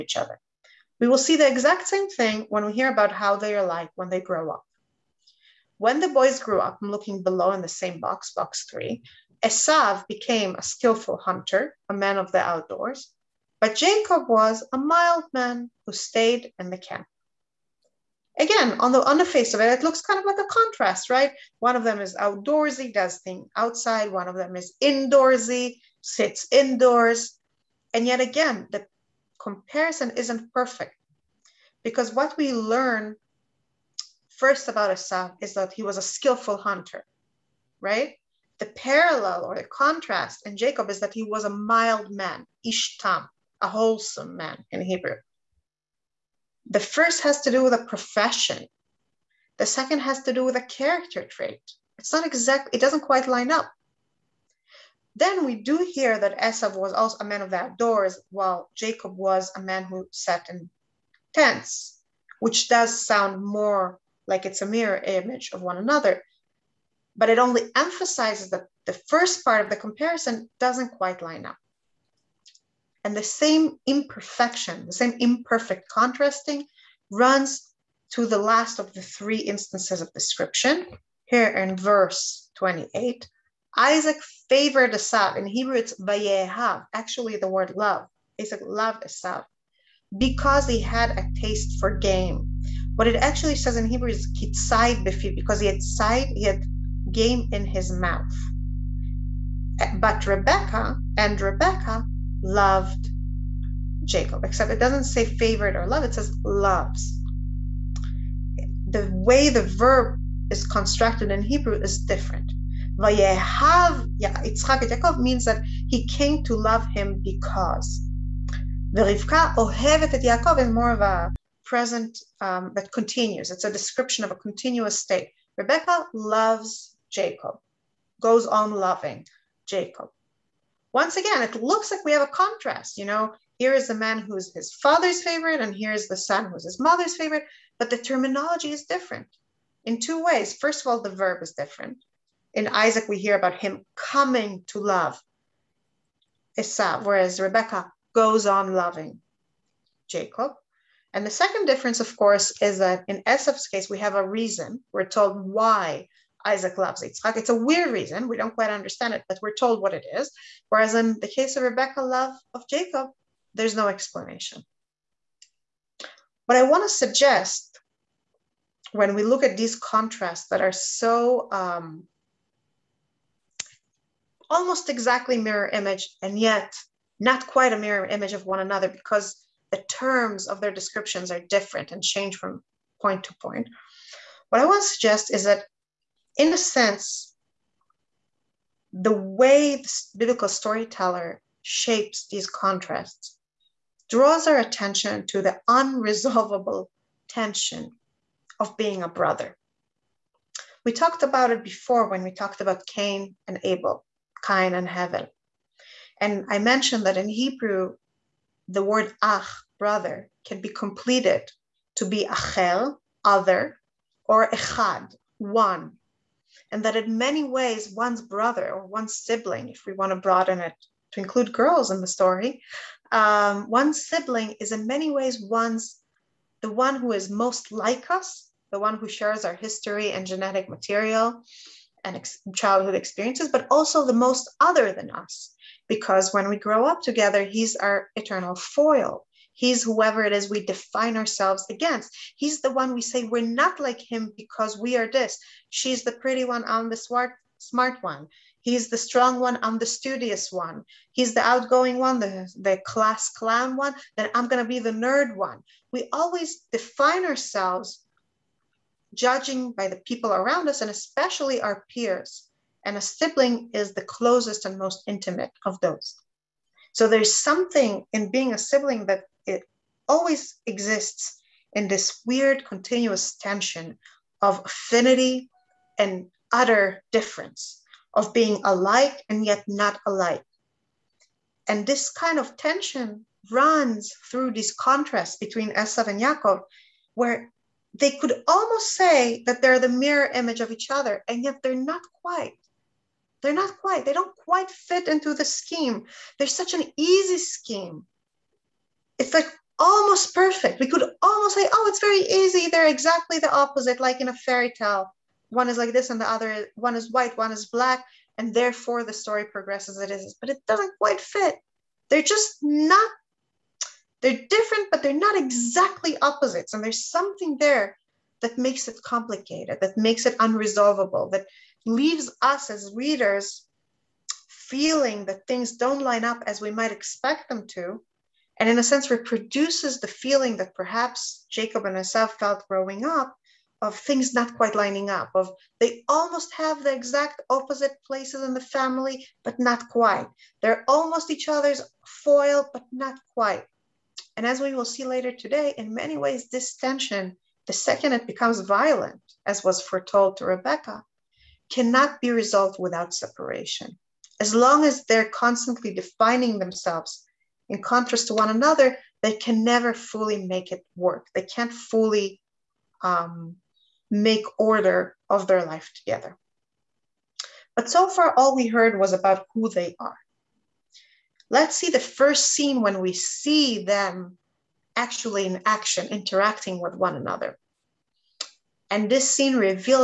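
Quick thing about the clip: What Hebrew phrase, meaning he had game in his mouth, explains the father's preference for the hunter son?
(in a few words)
kitzaid befiv.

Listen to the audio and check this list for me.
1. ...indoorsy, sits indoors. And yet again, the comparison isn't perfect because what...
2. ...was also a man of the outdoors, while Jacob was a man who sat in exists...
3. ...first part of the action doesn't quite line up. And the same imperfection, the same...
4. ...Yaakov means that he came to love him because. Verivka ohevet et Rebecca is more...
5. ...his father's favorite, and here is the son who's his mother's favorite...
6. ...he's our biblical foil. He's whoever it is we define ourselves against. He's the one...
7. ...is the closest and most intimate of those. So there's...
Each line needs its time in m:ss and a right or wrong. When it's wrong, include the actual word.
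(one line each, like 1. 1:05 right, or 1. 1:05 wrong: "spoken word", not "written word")
1. 0:24 right
2. 0:56 wrong: "tents", not "exists"
3. 1:09 wrong: "comparison", not "action"
4. 1:54 wrong: "Yaakov", not "Rebecca"
5. 2:14 right
6. 3:57 wrong: "eternal", not "biblical"
7. 4:23 right.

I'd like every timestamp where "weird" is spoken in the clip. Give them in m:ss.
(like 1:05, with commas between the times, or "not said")
2:37, 4:32.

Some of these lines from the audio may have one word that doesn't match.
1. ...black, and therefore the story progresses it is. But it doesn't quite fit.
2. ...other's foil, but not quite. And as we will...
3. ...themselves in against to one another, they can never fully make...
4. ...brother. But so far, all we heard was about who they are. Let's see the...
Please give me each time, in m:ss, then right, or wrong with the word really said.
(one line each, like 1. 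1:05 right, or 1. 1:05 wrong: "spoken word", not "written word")
1. 5:07 right
2. 5:41 right
3. 5:56 wrong: "contrast", not "against"
4. 6:05 wrong: "together", not "brother".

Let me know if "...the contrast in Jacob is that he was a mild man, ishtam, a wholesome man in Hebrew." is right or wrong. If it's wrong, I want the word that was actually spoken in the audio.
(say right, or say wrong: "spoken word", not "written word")
right.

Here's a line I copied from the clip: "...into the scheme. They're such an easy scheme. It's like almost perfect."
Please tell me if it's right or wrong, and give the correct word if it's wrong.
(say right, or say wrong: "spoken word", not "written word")
right.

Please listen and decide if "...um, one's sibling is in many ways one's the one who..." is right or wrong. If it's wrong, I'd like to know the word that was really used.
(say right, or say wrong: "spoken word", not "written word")
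right.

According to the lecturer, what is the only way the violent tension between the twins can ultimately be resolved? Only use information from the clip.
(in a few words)
separation.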